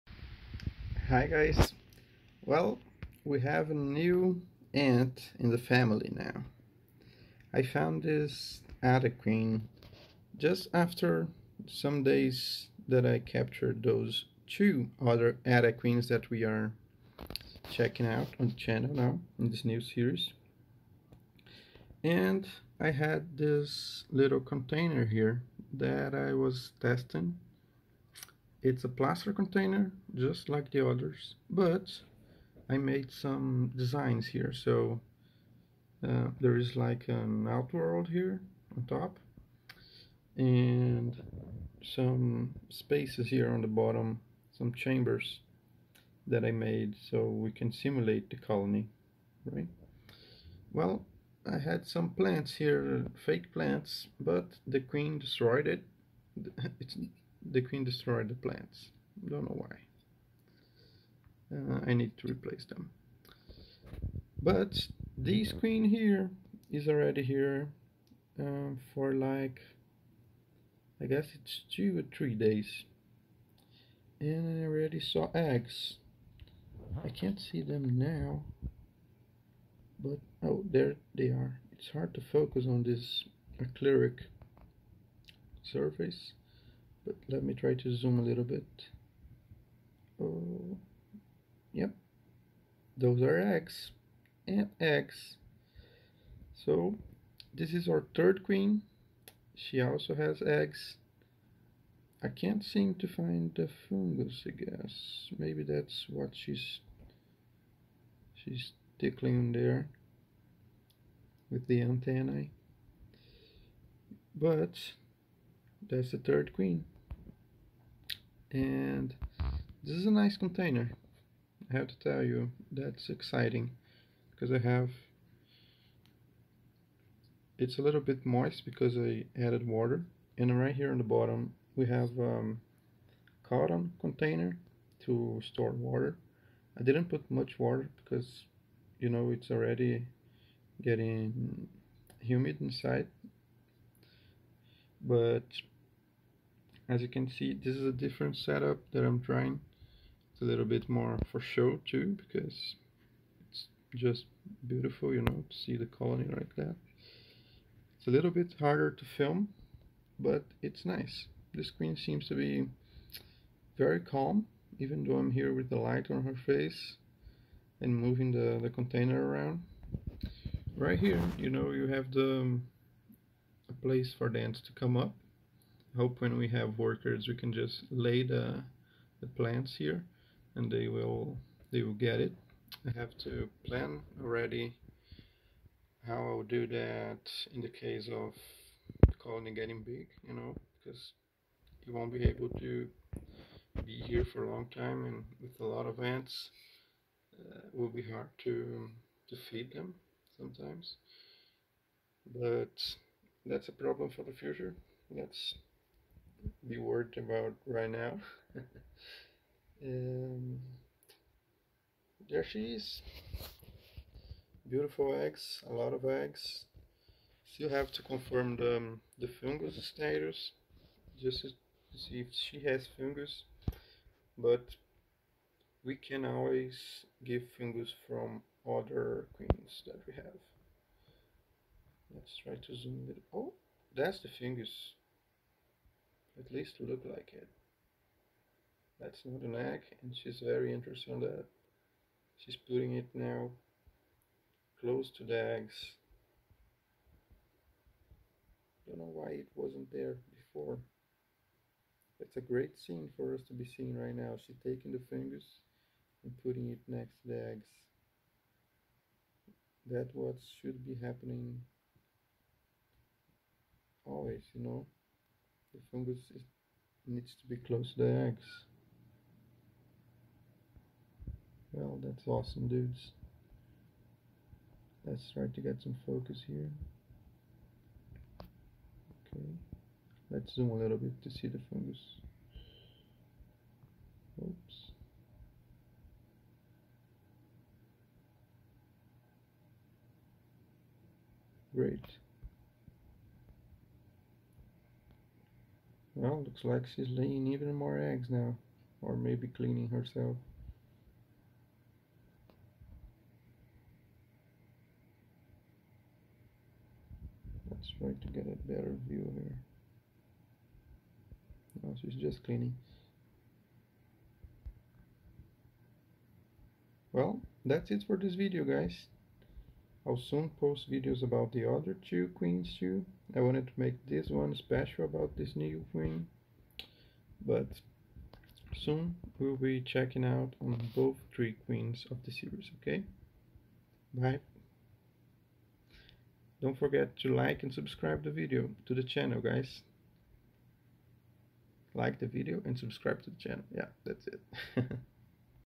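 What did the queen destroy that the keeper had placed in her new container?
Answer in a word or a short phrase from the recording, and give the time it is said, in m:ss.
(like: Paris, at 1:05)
Fake plants, at 0:53.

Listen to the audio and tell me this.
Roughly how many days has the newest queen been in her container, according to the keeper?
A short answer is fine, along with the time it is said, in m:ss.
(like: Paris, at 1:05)
2 or 3 days, at 1:11.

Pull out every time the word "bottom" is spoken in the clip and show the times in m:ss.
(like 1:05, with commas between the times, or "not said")
0:43, 2:11.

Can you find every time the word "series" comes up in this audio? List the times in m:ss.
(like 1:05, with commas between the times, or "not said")
0:19, 5:32.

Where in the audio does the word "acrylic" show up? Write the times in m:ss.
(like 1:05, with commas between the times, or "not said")
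1:23.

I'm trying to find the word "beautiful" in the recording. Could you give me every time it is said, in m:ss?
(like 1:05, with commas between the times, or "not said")
2:34, 3:34.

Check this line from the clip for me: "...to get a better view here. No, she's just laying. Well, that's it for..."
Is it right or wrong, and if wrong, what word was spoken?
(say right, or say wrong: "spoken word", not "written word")
wrong: "cleaning", not "laying".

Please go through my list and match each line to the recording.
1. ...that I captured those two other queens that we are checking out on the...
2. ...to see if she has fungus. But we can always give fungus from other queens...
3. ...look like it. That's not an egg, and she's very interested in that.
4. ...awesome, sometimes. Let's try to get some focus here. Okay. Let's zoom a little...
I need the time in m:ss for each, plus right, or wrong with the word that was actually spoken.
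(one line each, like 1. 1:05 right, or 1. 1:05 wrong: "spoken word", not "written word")
1. 0:12 right
2. 3:41 right
3. 3:56 right
4. 4:32 wrong: "dudes", not "sometimes".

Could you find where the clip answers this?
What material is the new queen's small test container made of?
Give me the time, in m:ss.
0:28.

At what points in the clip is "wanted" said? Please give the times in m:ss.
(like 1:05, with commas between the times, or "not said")
5:23.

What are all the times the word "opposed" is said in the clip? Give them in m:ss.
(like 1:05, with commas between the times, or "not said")
not said.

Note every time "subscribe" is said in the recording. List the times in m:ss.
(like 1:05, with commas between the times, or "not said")
5:37, 5:42.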